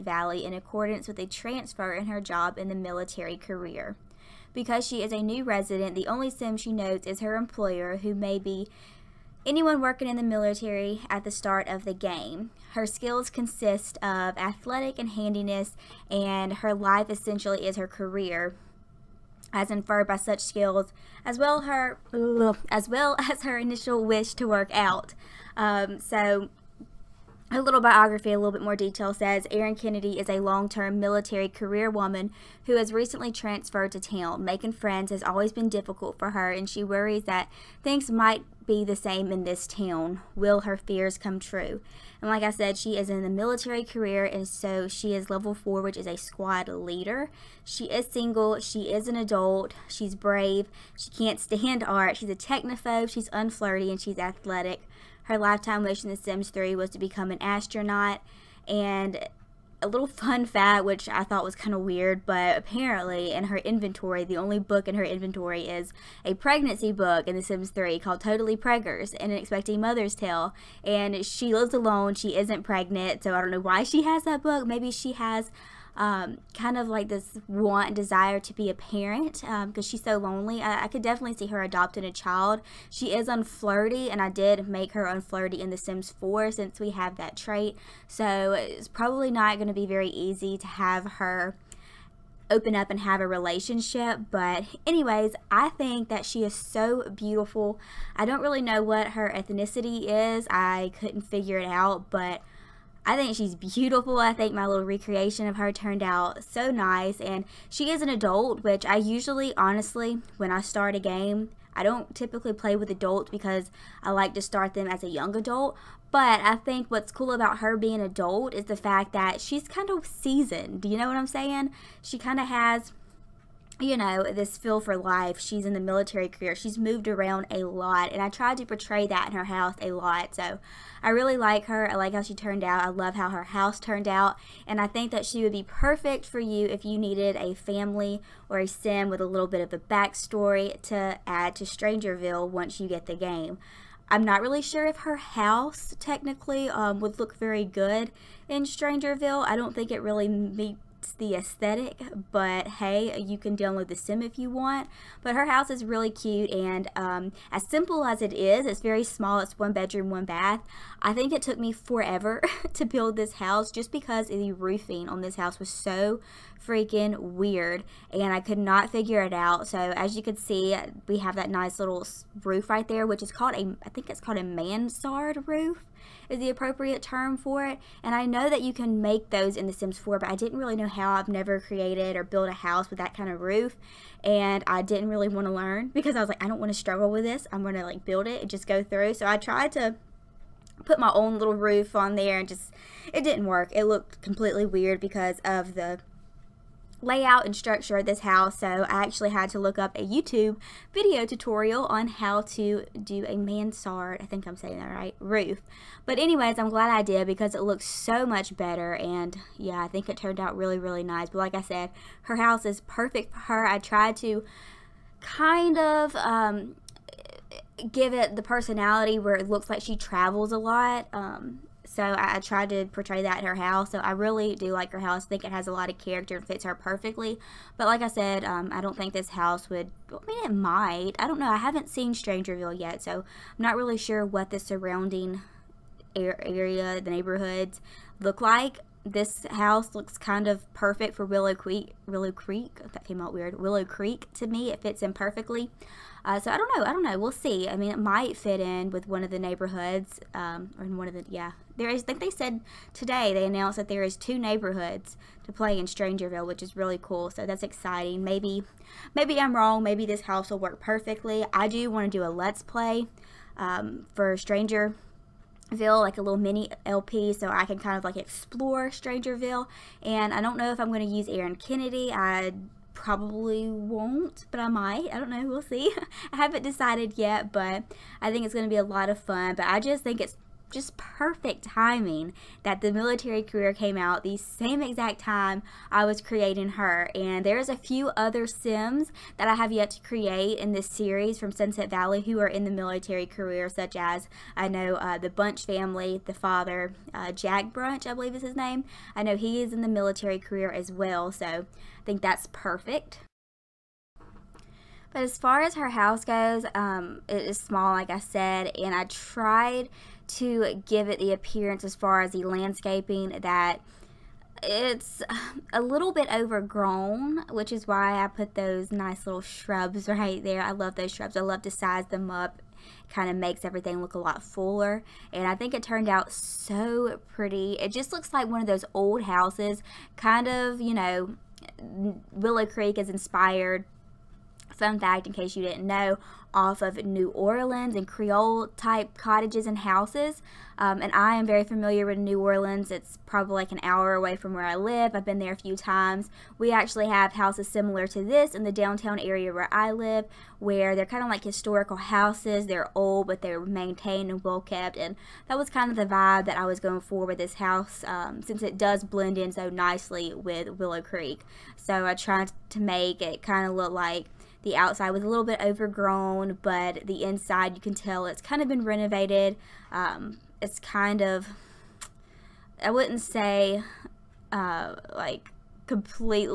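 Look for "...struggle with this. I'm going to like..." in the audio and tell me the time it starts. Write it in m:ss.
3:06.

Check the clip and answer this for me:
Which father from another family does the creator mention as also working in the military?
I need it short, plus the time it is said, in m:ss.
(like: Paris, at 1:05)
Jack Bunch, at 4:57.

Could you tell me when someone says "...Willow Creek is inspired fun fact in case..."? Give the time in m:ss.
5:32.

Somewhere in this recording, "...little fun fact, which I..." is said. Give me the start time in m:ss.
0:59.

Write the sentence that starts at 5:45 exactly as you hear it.
I've been there a few times.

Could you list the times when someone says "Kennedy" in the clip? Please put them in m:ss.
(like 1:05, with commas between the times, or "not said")
0:29, 4:31.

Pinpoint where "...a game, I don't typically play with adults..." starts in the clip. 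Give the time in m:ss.
1:50.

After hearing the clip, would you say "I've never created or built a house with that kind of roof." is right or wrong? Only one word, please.
right.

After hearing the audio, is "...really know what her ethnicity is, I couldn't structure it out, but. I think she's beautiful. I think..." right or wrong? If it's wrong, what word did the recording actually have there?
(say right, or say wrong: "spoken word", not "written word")
wrong: "figure", not "structure".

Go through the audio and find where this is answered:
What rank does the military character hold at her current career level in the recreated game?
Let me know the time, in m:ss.
0:46.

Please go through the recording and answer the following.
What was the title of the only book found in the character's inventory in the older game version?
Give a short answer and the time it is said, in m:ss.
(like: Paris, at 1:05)
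Totally Preggers, at 1:08.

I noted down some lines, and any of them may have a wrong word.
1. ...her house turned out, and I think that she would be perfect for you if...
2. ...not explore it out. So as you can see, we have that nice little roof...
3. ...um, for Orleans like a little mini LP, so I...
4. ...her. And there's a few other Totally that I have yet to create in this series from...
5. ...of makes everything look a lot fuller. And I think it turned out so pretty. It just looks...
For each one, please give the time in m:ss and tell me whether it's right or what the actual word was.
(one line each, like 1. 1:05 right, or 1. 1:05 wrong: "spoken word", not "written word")
1. 2:13 right
2. 2:48 wrong: "figure", not "explore"
3. 4:23 wrong: "Stranger", not "Orleans"
4. 4:46 wrong: "Sims", not "Totally"
5. 5:23 right.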